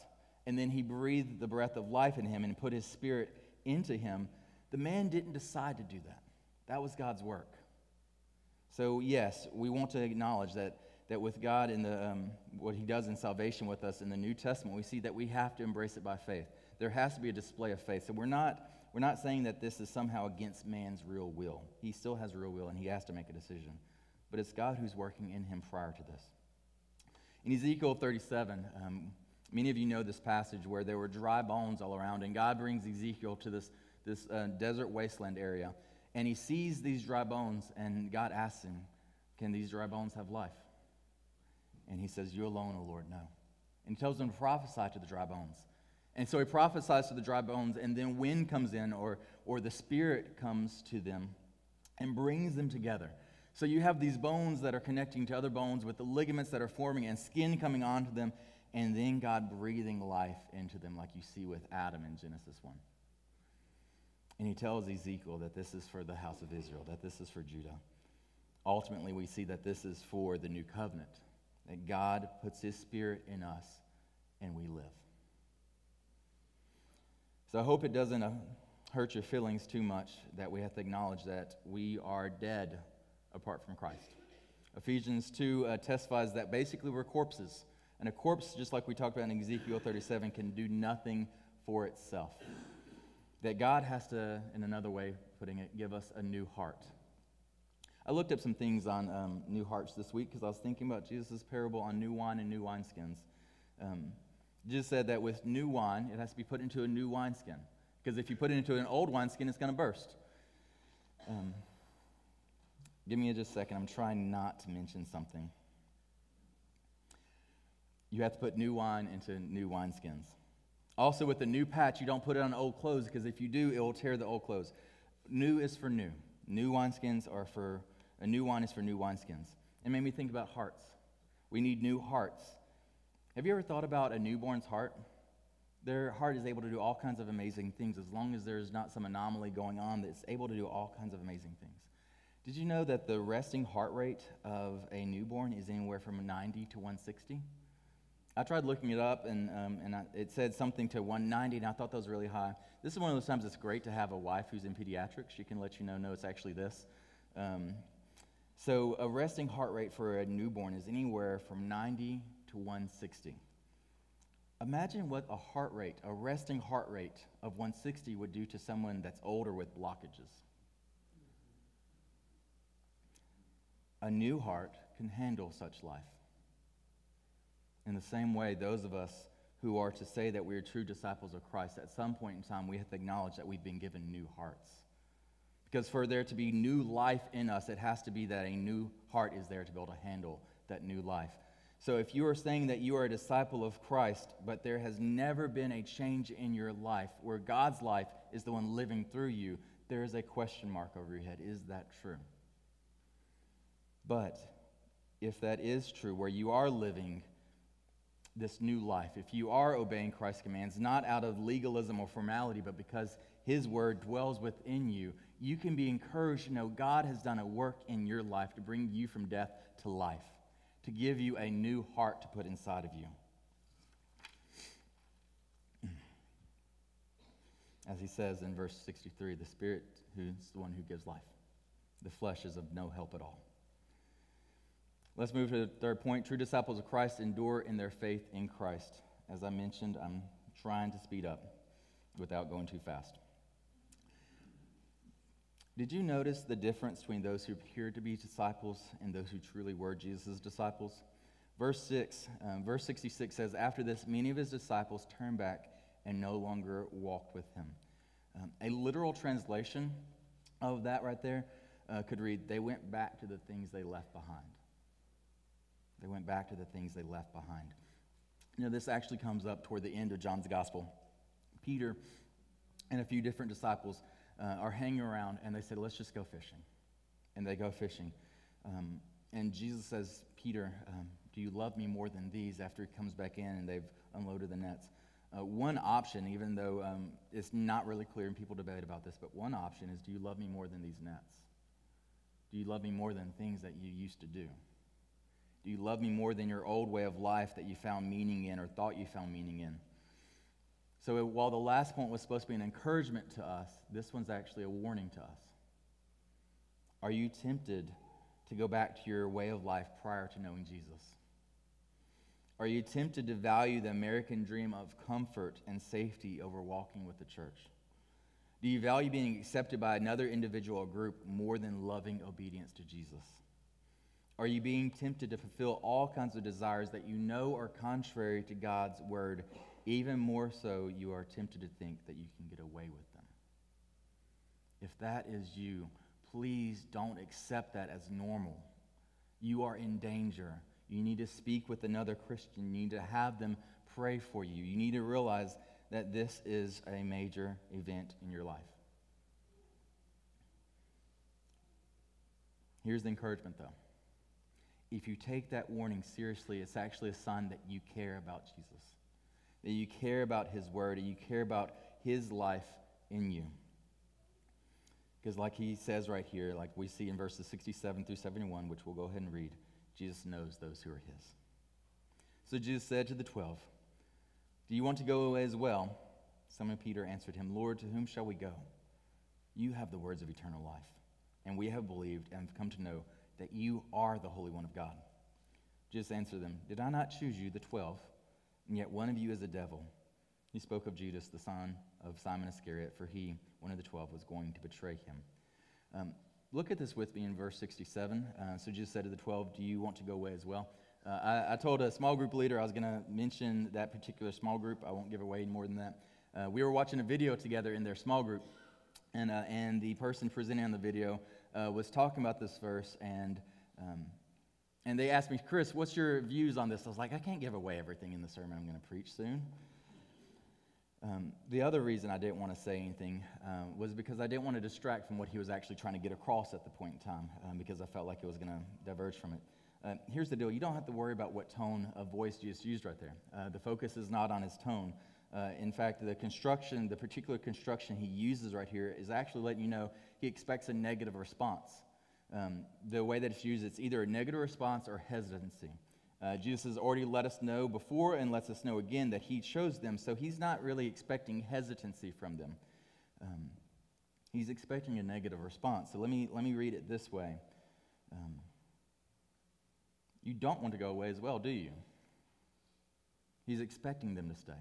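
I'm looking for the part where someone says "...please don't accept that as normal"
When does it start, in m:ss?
5:36.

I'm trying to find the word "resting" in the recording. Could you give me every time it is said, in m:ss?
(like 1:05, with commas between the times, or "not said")
2:23, 2:39, 2:46.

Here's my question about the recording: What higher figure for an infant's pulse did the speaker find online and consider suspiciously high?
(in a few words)
190.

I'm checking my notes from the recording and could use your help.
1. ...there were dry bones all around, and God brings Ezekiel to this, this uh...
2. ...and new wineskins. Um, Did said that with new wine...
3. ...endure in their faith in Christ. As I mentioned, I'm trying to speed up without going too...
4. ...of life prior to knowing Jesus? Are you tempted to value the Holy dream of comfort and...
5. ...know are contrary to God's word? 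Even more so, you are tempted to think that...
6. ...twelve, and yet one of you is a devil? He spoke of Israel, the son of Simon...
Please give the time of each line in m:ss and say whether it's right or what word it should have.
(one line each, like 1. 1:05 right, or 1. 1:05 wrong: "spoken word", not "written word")
1. 0:30 right
2. 1:42 wrong: "Jesus", not "Did"
3. 3:57 right
4. 5:09 wrong: "American", not "Holy"
5. 5:27 right
6. 6:27 wrong: "Judas", not "Israel".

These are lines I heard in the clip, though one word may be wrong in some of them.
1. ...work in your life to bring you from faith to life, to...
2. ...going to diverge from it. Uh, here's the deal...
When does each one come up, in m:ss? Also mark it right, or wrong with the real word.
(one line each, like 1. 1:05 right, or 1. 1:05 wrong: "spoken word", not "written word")
1. 3:37 wrong: "death", not "faith"
2. 7:08 right.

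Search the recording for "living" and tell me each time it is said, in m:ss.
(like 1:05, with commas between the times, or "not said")
3:18, 3:26.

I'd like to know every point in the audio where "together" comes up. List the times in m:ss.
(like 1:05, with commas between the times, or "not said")
0:52, 6:47.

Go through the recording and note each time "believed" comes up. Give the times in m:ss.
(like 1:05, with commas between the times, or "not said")
6:21.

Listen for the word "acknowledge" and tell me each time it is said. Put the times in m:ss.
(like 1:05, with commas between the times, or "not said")
0:10, 1:20, 3:02.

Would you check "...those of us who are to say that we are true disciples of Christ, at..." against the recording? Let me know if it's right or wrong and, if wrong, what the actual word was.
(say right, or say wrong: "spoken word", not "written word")
right.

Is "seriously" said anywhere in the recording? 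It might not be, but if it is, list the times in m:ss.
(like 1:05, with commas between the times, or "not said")
5:56.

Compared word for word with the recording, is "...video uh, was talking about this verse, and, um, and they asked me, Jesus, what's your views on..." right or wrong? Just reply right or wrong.
wrong.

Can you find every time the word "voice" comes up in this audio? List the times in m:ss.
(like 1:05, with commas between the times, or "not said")
7:12.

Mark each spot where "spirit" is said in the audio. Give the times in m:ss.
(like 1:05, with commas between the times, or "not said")
0:02, 0:49, 1:12, 3:49.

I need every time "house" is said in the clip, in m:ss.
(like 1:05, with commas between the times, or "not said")
1:06.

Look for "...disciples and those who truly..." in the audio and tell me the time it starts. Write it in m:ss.
4:08.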